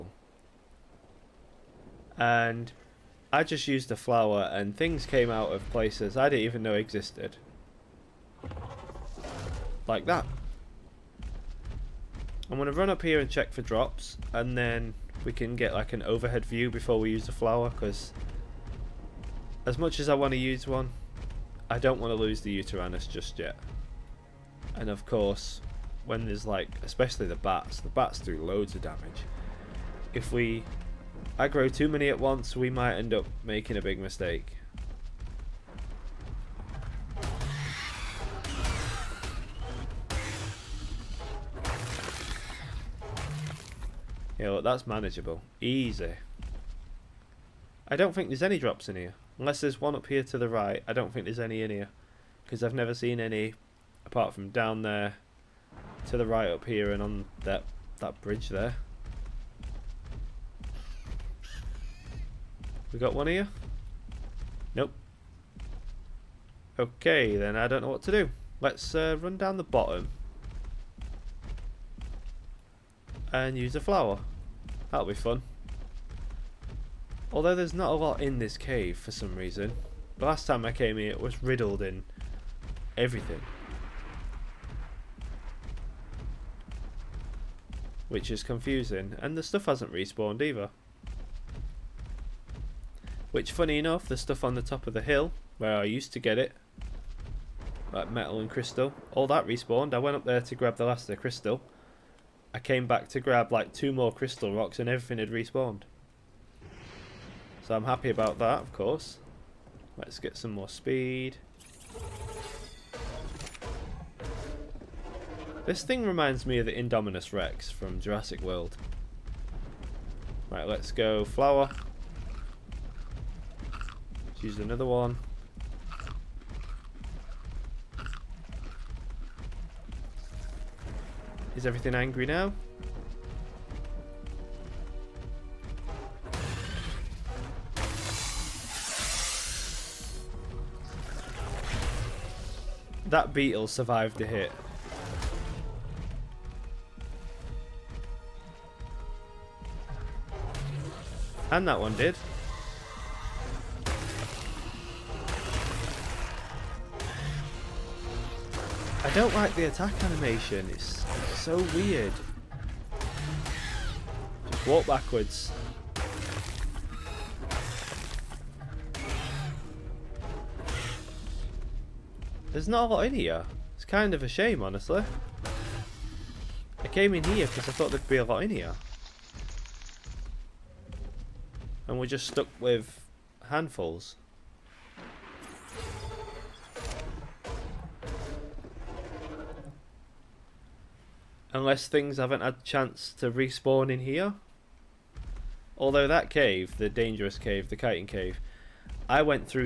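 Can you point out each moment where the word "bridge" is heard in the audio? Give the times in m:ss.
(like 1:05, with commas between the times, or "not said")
0:58.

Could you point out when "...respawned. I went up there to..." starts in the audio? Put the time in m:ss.
1:39.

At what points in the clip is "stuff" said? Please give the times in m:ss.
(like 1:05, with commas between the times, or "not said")
1:29, 1:34.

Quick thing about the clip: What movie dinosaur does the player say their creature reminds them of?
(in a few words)
Indominus Rex.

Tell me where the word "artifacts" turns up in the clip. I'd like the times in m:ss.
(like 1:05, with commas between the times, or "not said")
not said.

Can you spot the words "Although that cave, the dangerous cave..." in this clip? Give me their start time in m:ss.
3:15.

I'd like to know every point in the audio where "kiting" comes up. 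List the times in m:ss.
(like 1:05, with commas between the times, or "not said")
3:17.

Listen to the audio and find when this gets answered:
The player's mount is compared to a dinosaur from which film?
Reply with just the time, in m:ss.
1:58.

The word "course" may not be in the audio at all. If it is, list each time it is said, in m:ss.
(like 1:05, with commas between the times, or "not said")
0:25, 1:48.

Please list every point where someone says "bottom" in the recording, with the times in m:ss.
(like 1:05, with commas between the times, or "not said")
1:09.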